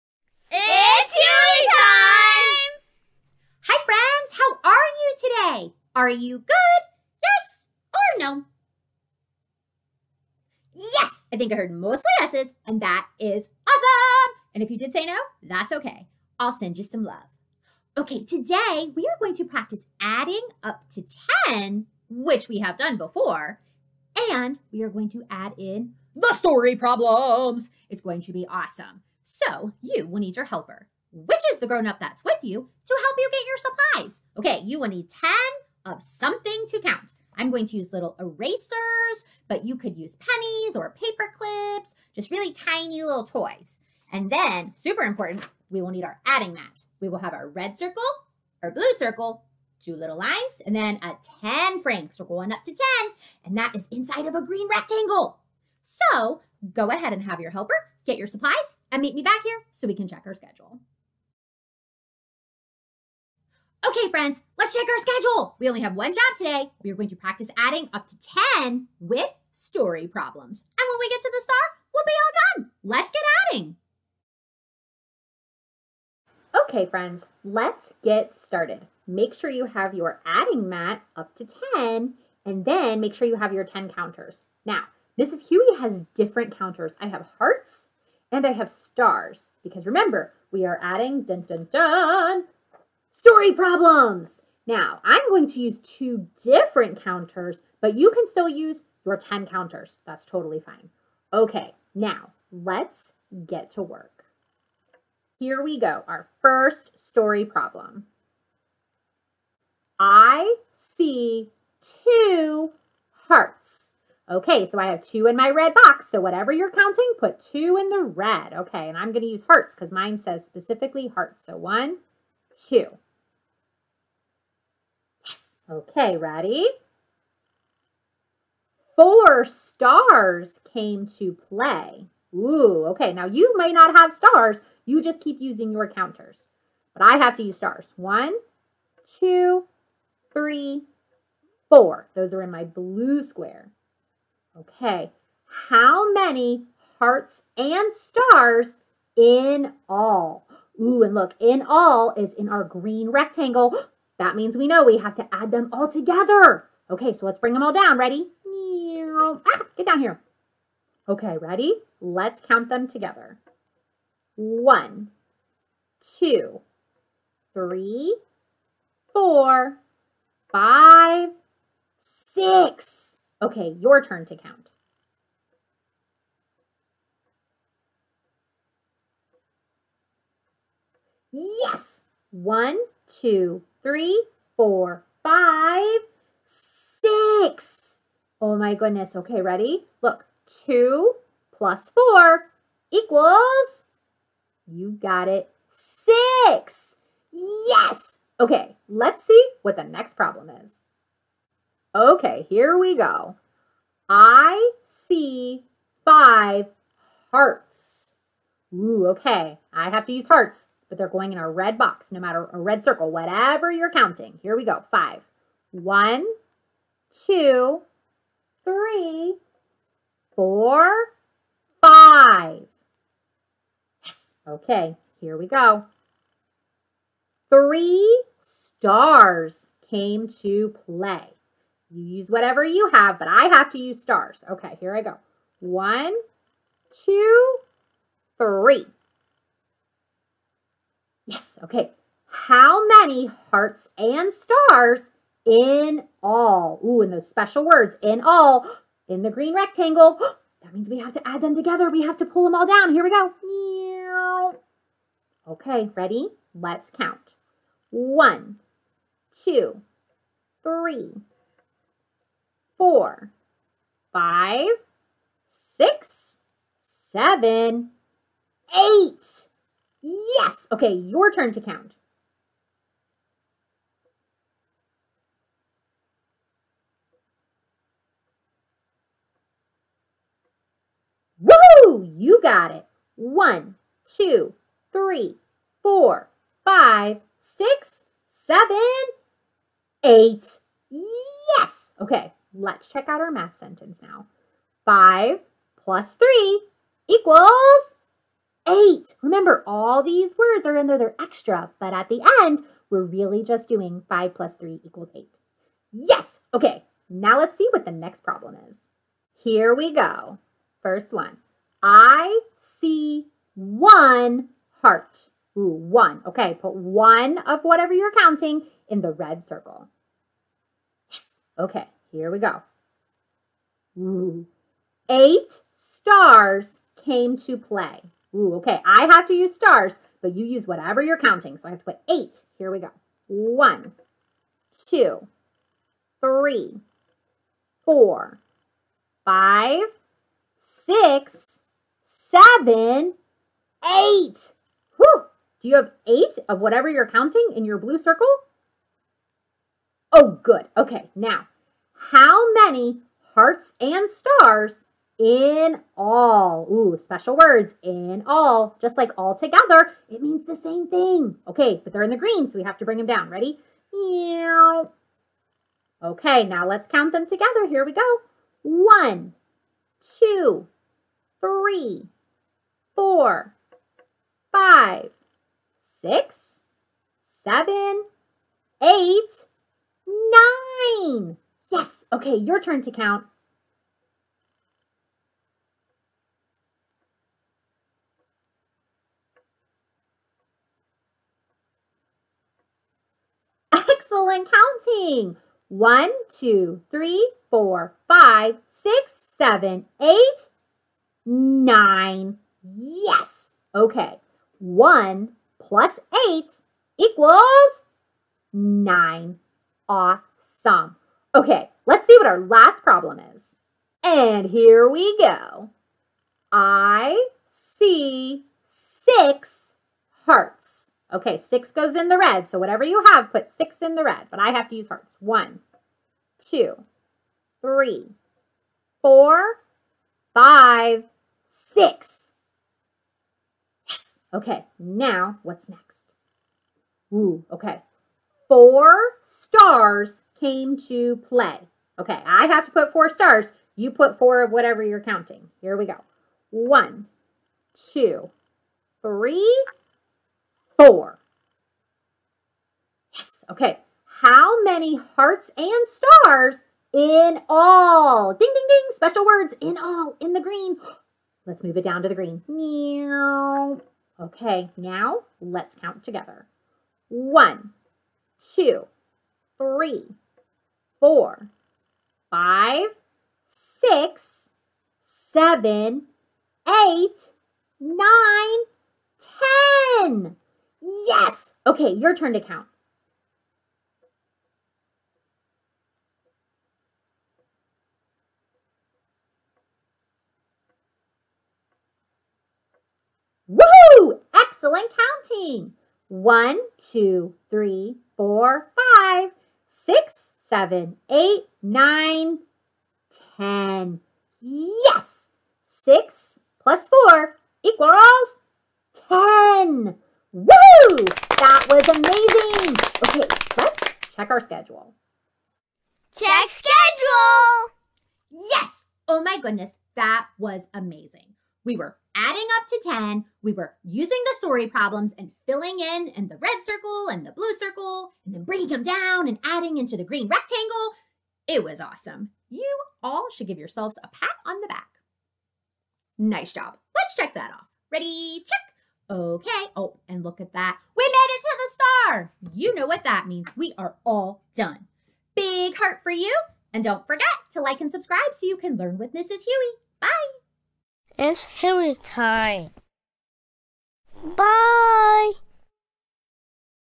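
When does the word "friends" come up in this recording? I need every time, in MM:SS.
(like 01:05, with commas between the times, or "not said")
01:04, 01:16.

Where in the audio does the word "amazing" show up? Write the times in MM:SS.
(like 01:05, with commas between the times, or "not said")
08:31, 08:40.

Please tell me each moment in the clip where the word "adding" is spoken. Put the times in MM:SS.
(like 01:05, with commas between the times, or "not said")
00:20, 00:46, 01:07, 01:13, 01:20, 01:30, 08:42, 08:49.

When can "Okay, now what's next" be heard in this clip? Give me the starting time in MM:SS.
07:14.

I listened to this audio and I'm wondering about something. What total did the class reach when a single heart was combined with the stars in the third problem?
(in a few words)
9.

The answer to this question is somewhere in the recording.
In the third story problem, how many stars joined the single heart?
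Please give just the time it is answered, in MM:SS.
05:25.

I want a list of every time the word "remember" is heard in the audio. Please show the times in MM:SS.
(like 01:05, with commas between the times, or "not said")
01:29, 04:59.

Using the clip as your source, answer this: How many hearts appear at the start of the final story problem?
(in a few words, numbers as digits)
6.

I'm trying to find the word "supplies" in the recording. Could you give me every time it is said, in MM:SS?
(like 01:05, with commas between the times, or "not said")
00:33, 00:58.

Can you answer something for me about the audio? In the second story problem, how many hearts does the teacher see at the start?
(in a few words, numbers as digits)
5.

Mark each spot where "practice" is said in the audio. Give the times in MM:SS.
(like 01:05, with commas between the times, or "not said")
00:19, 01:07.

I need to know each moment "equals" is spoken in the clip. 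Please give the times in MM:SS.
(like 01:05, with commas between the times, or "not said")
03:12, 04:57, 05:04, 06:46, 08:27.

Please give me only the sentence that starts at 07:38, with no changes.
Ding, ding, ding, special words, in all, in the green.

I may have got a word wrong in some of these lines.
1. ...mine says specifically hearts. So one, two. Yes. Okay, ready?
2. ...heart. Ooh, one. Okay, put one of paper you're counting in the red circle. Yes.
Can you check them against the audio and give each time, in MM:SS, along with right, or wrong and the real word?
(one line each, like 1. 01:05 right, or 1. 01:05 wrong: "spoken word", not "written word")
1. 01:59 right
2. 05:14 wrong: "whatever", not "paper".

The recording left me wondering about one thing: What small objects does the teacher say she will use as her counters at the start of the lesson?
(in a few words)
little erasers.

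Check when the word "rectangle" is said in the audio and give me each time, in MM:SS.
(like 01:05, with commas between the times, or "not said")
00:54, 02:33, 04:09, 08:50.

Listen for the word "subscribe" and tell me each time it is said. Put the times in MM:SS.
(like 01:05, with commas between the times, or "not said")
09:07.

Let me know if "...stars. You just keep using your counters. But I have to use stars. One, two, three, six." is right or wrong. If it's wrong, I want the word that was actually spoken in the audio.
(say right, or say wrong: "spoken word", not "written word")
wrong: "four", not "six".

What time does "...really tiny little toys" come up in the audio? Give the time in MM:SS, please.
00:42.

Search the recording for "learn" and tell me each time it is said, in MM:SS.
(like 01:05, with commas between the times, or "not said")
09:08.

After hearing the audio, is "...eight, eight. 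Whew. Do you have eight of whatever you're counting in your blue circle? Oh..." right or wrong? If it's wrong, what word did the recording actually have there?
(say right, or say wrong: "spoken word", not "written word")
wrong: "seven", not "eight".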